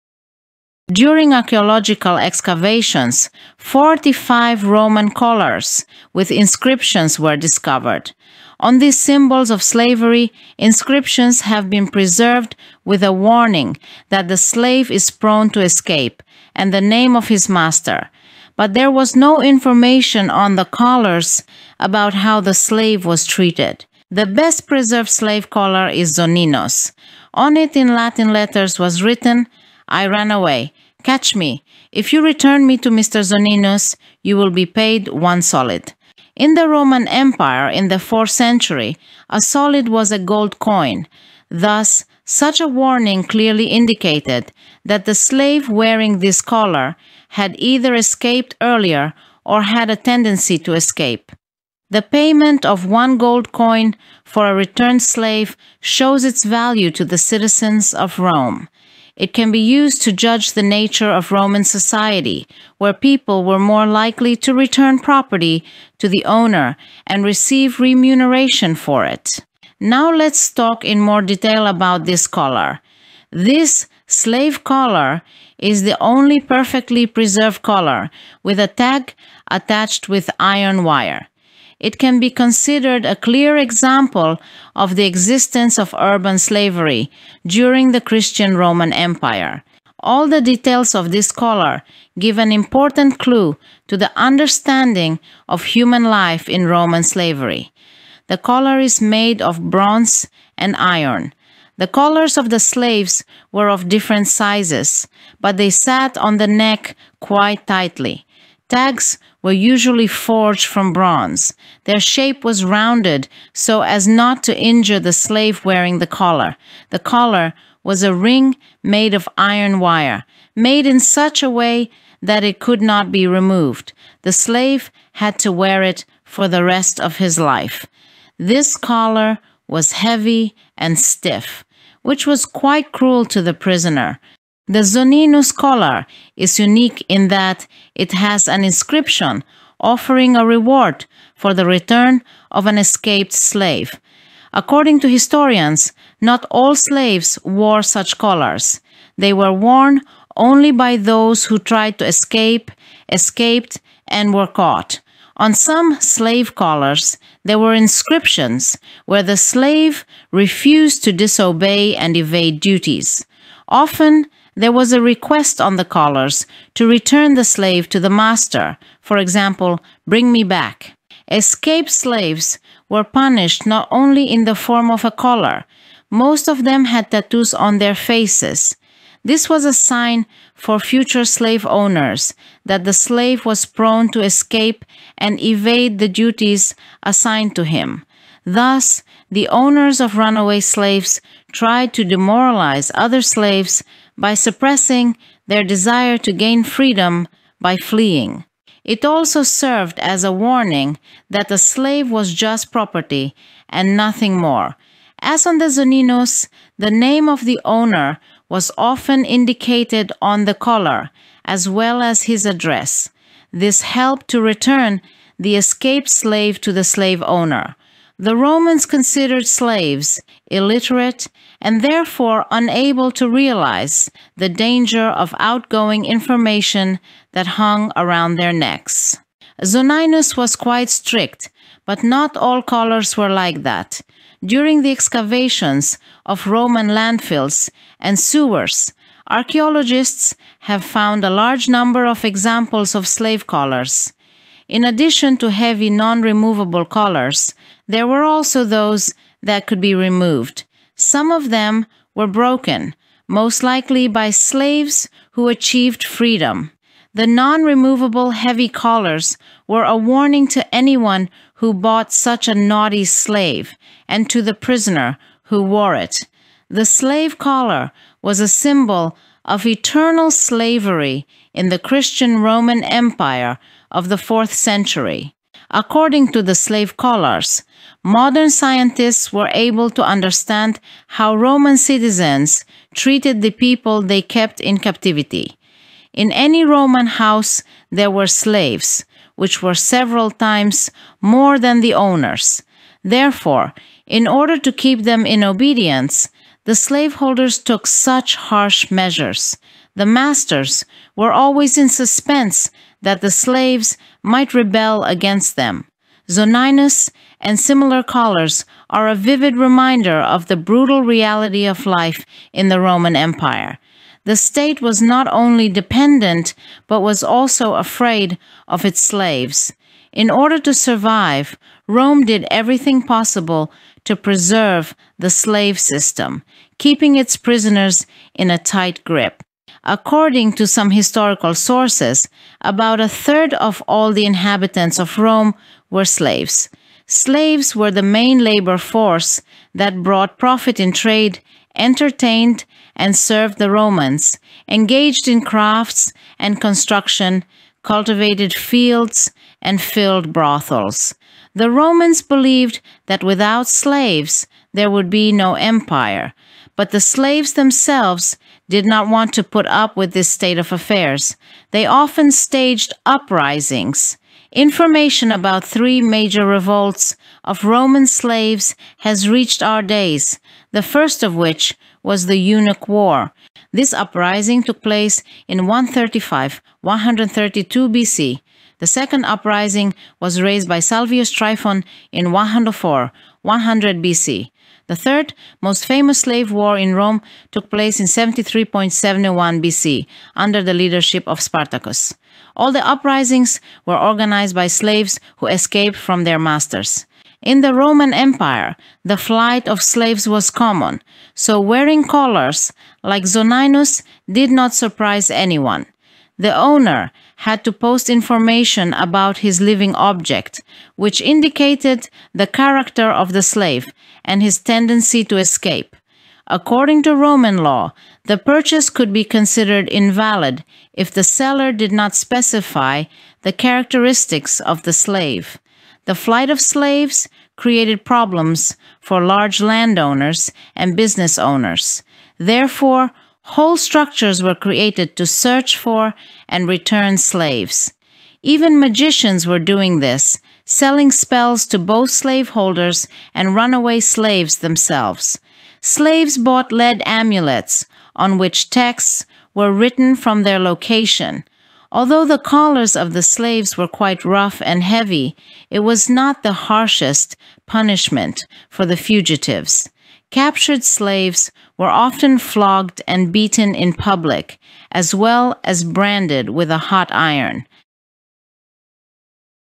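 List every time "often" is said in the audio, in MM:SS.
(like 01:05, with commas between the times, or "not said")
02:43, 03:28, 06:01, 07:41.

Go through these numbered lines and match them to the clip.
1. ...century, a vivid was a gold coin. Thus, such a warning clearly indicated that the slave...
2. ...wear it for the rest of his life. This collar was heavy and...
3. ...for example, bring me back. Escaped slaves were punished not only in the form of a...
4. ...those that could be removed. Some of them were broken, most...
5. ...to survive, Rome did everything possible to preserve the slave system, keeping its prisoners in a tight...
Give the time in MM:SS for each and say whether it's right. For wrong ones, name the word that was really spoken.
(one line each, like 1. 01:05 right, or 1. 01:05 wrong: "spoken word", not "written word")
1. 00:38 wrong: "solid", not "vivid"
2. 02:05 right
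3. 02:48 right
4. 04:08 right
5. 05:20 right.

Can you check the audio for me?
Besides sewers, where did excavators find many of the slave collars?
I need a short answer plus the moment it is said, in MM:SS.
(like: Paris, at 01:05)
landfills, at 03:56.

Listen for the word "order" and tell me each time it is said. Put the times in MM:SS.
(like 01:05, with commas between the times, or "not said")
04:54, 05:20.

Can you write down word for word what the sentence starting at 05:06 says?
Zoninus and similar callers are a vivid reminder of the brutal reality of life in the Roman Empire.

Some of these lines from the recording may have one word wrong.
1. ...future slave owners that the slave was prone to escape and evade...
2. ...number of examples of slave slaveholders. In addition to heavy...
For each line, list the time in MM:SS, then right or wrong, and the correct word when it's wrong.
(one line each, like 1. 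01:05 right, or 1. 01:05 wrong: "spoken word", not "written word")
1. 03:00 right
2. 04:01 wrong: "collars", not "slaveholders".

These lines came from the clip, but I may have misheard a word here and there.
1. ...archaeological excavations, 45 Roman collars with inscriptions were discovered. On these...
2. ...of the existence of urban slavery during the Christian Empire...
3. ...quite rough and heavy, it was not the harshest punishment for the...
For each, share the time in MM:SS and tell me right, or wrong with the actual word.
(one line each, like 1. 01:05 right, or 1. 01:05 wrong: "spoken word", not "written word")
1. 00:01 right
2. 01:24 wrong: "Roman", not "Empire"
3. 07:33 right.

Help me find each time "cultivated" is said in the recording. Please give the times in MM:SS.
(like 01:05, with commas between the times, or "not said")
05:47.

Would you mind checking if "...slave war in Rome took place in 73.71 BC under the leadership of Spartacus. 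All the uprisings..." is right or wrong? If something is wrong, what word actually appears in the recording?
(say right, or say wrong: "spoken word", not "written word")
right.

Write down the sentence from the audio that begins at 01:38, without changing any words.
The collar is made of bronze and iron.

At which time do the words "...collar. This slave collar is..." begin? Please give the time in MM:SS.
01:12.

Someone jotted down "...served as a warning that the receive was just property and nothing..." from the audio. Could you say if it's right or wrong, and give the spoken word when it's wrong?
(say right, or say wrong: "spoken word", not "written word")
wrong: "slave", not "receive".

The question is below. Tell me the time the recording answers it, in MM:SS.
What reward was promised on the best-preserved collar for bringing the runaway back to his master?
00:35.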